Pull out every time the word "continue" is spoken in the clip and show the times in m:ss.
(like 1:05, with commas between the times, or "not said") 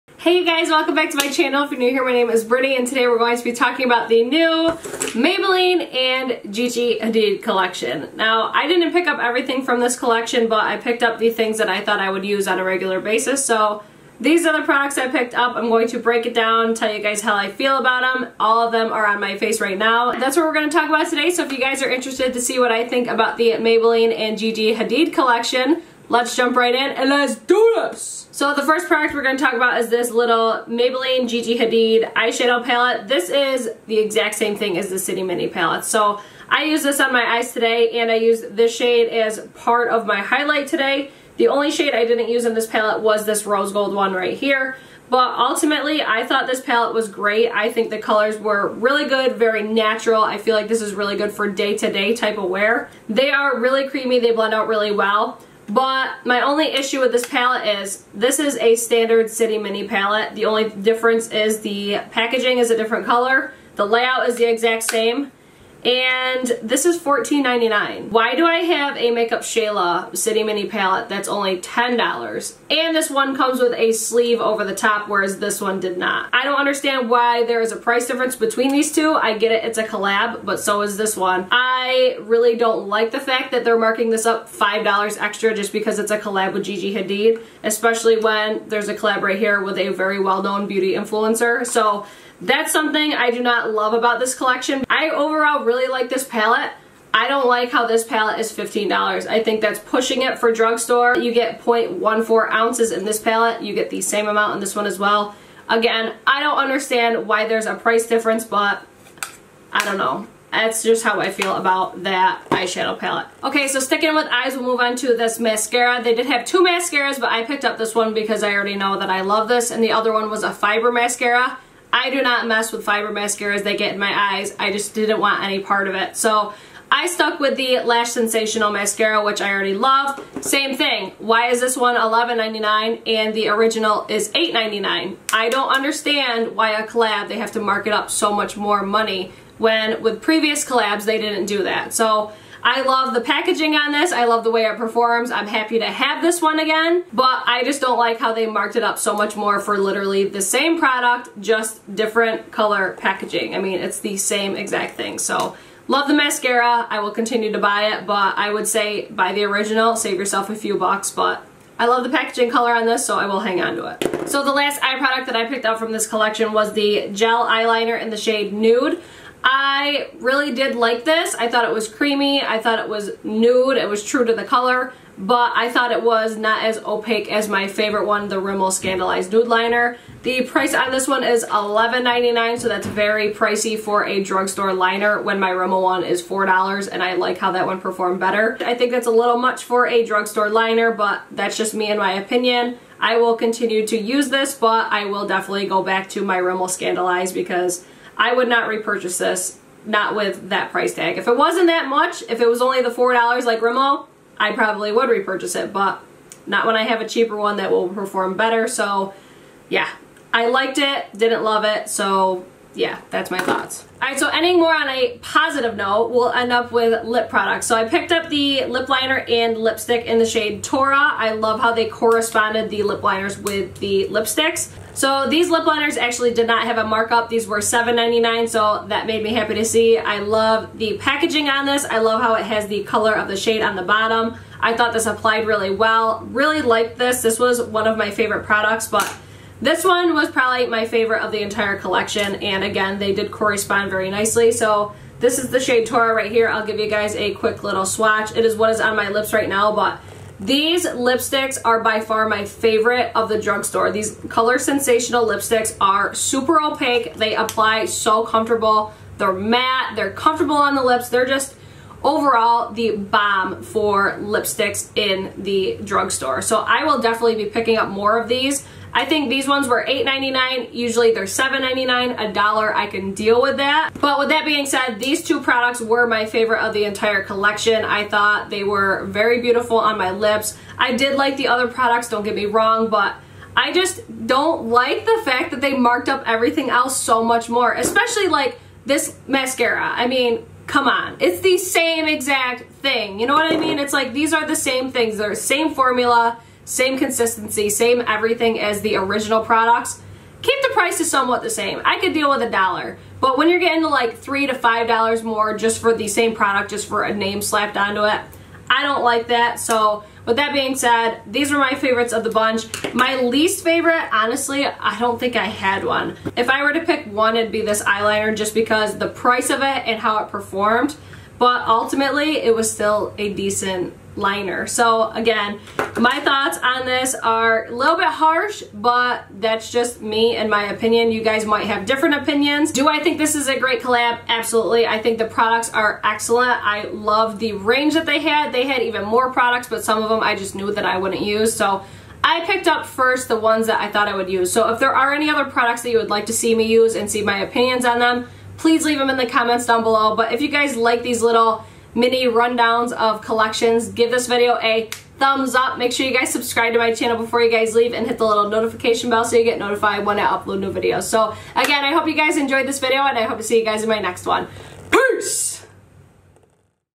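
2:37, 3:13.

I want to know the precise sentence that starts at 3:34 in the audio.
All right, so ending more on a positive note, we'll end up with lip products.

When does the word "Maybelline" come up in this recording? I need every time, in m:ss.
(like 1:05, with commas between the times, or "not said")
0:05, 0:23, 0:30.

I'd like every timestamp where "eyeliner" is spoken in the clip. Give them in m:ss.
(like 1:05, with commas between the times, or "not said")
2:47, 5:17.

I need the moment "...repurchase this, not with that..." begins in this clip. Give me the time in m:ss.
3:18.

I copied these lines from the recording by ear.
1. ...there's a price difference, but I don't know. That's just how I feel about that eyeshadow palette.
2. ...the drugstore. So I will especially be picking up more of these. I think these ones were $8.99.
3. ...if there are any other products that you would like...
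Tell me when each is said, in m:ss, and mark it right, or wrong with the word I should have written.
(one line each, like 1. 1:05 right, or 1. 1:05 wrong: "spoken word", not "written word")
1. 1:47 right
2. 4:25 wrong: "definitely", not "especially"
3. 5:44 right.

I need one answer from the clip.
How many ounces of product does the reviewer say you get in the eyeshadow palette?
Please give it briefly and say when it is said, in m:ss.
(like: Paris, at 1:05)
0.14 ounces, at 1:41.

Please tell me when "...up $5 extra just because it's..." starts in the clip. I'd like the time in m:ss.
1:24.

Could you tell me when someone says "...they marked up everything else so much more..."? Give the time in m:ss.
4:45.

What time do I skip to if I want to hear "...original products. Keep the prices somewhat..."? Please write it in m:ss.
4:58.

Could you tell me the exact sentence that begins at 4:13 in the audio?
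These Color Sensational lipsticks are super opaque.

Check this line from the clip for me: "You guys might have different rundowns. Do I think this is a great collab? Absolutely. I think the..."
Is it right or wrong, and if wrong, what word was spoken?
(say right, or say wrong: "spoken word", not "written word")
wrong: "opinions", not "rundowns".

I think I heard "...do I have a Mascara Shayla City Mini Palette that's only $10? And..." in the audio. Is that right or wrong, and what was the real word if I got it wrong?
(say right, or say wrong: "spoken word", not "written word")
wrong: "Makeup", not "Mascara".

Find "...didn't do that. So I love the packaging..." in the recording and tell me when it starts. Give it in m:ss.
2:21.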